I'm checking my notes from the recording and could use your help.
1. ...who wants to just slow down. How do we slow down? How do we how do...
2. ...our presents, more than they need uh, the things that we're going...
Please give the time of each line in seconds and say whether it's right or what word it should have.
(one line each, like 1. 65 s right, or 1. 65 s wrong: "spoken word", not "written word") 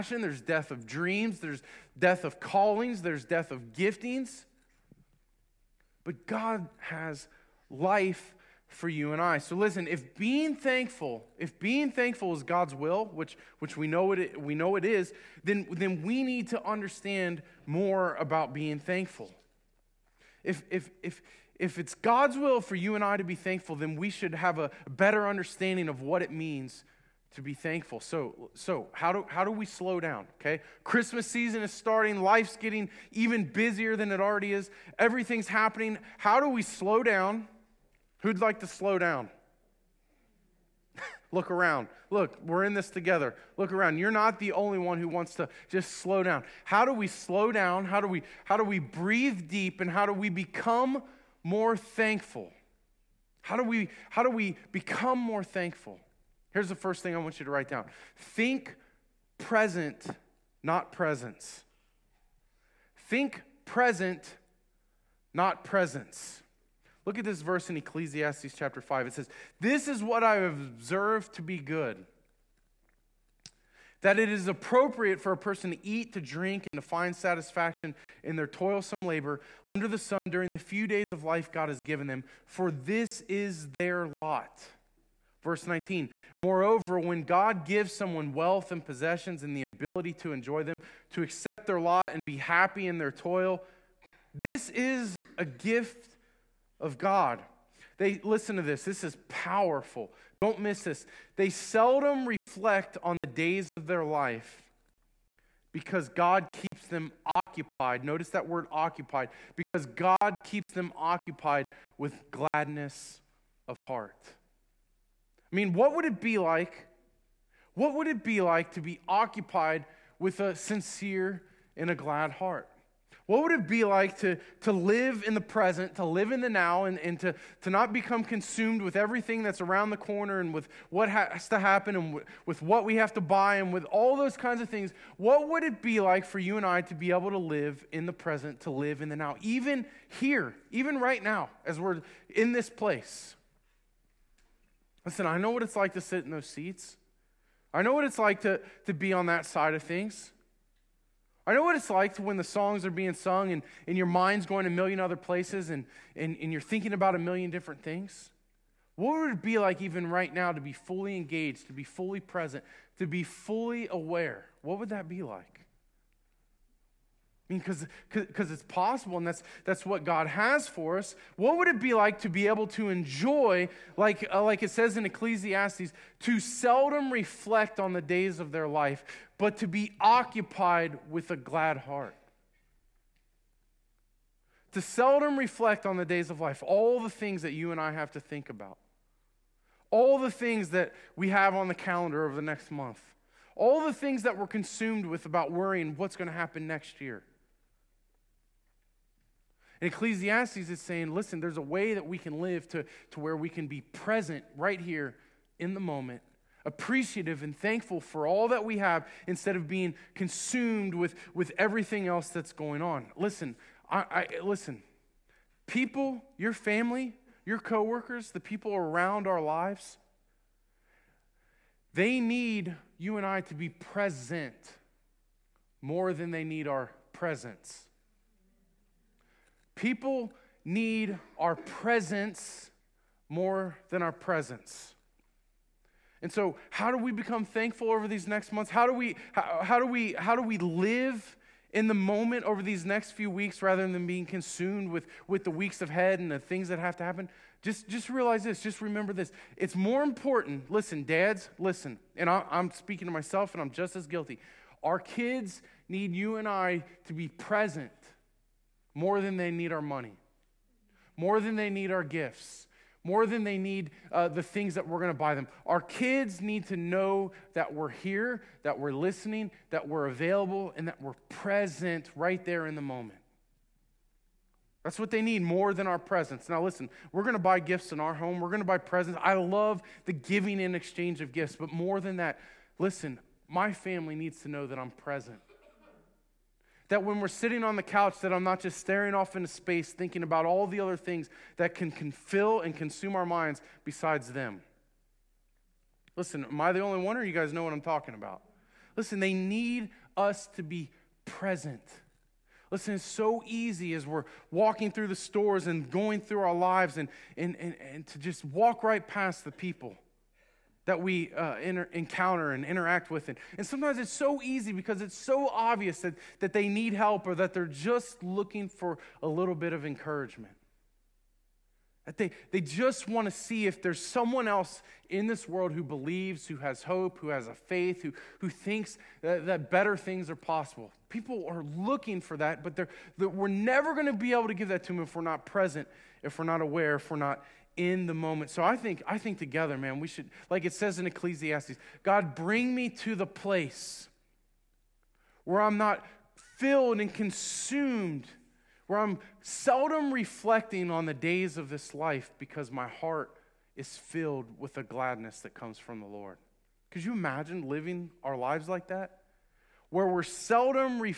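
1. 44 s right
2. 261 s wrong: "gifts", not "presents".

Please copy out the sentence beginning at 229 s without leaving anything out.
People need our presence more than our presents.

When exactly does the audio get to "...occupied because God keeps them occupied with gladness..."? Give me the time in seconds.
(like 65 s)
108 s.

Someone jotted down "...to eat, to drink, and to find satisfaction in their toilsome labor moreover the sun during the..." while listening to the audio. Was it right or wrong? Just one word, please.
wrong.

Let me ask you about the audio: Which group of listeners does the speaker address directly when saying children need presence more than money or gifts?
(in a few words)
Dads.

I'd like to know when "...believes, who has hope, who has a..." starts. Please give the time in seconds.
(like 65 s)
325 s.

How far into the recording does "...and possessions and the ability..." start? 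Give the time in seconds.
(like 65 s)
88 s.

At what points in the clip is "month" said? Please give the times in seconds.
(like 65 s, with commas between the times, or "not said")
192 s, 238 s.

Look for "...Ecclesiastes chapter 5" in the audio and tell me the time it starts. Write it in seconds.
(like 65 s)
67 s.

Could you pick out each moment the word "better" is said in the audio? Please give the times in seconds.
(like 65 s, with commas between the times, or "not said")
24 s, 329 s.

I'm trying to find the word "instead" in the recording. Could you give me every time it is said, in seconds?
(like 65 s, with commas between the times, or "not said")
209 s.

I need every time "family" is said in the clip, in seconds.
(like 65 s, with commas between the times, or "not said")
216 s, 283 s.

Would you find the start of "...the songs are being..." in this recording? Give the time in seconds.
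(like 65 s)
152 s.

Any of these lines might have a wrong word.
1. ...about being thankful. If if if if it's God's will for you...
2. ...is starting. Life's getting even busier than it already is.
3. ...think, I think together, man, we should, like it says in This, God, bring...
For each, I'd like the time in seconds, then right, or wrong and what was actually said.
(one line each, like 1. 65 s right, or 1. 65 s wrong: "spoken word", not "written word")
1. 18 s right
2. 31 s right
3. 338 s wrong: "Ecclesiastes", not "This".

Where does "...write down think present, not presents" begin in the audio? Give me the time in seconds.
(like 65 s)
57 s.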